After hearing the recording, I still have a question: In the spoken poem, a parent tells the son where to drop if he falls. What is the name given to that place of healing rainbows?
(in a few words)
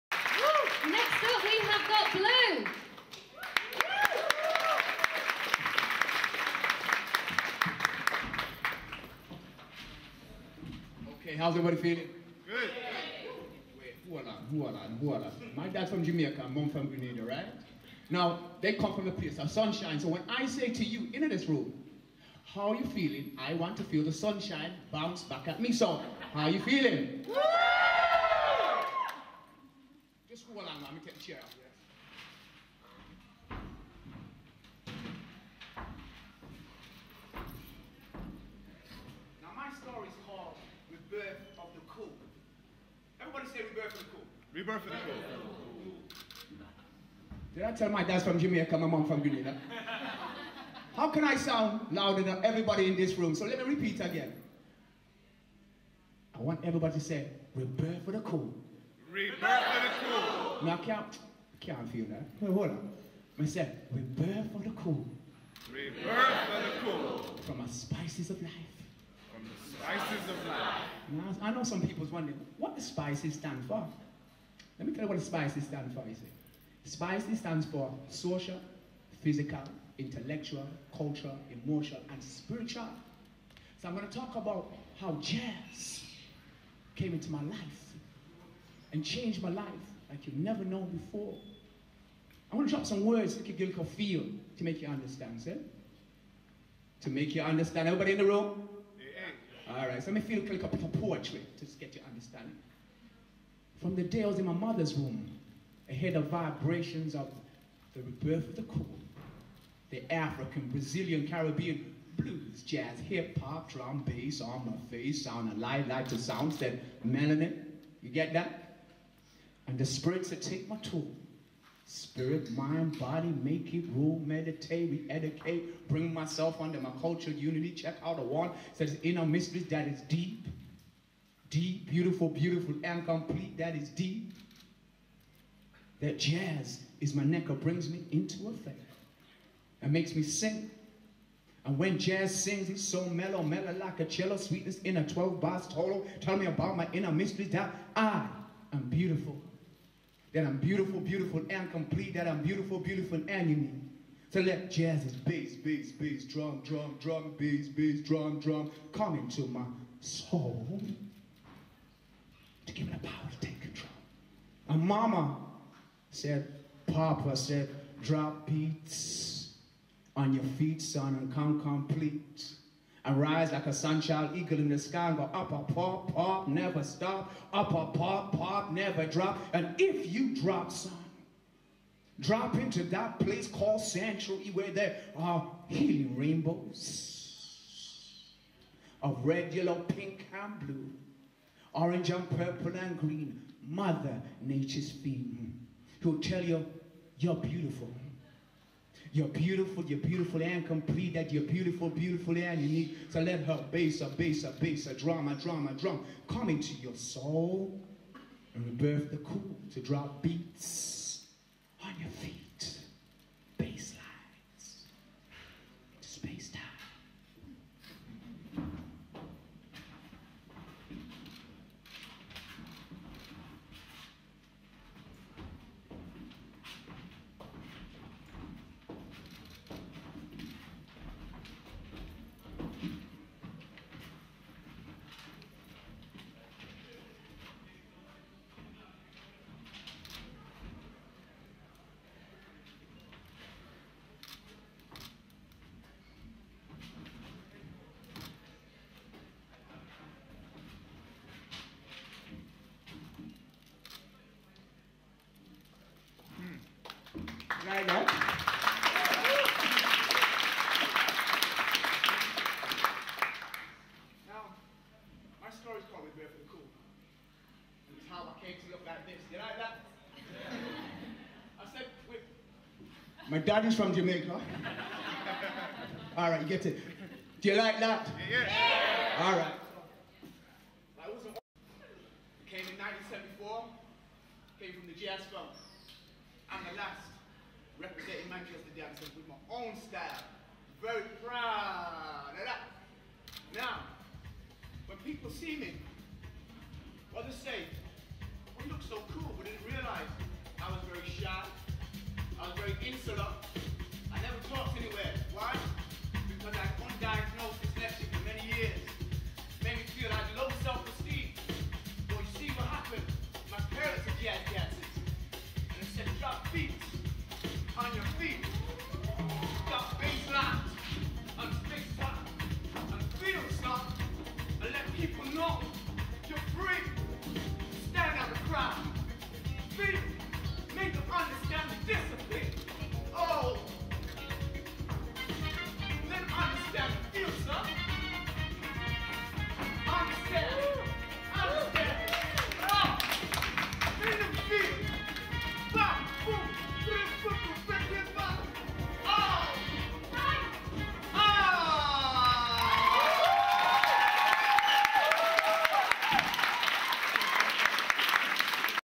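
Sanctuary.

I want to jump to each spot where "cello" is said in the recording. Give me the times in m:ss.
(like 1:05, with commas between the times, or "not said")
2:24.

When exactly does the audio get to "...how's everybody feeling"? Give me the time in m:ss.
0:11.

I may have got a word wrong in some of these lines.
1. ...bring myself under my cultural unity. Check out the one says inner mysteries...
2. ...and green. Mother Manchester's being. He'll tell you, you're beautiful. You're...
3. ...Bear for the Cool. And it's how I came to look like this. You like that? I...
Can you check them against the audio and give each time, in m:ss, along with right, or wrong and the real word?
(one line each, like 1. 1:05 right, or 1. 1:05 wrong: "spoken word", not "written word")
1. 2:05 right
2. 3:12 wrong: "Nature", not "Manchester"
3. 4:26 right.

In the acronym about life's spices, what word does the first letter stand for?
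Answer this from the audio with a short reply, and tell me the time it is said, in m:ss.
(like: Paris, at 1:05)
Social, at 1:18.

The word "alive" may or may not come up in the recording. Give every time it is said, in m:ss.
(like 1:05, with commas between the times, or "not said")
1:55.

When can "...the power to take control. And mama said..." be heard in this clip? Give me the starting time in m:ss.
2:42.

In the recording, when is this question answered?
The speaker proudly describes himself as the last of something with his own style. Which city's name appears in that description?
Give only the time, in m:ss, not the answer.
4:48.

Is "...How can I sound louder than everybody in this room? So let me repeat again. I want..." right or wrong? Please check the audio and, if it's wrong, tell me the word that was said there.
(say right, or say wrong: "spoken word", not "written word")
right.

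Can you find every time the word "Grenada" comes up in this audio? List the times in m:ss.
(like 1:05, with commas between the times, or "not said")
0:16, 0:49.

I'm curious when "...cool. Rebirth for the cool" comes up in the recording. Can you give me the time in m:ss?
1:04.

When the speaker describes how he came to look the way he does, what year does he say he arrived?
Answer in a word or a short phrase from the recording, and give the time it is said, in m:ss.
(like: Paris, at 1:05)
1974, at 4:42.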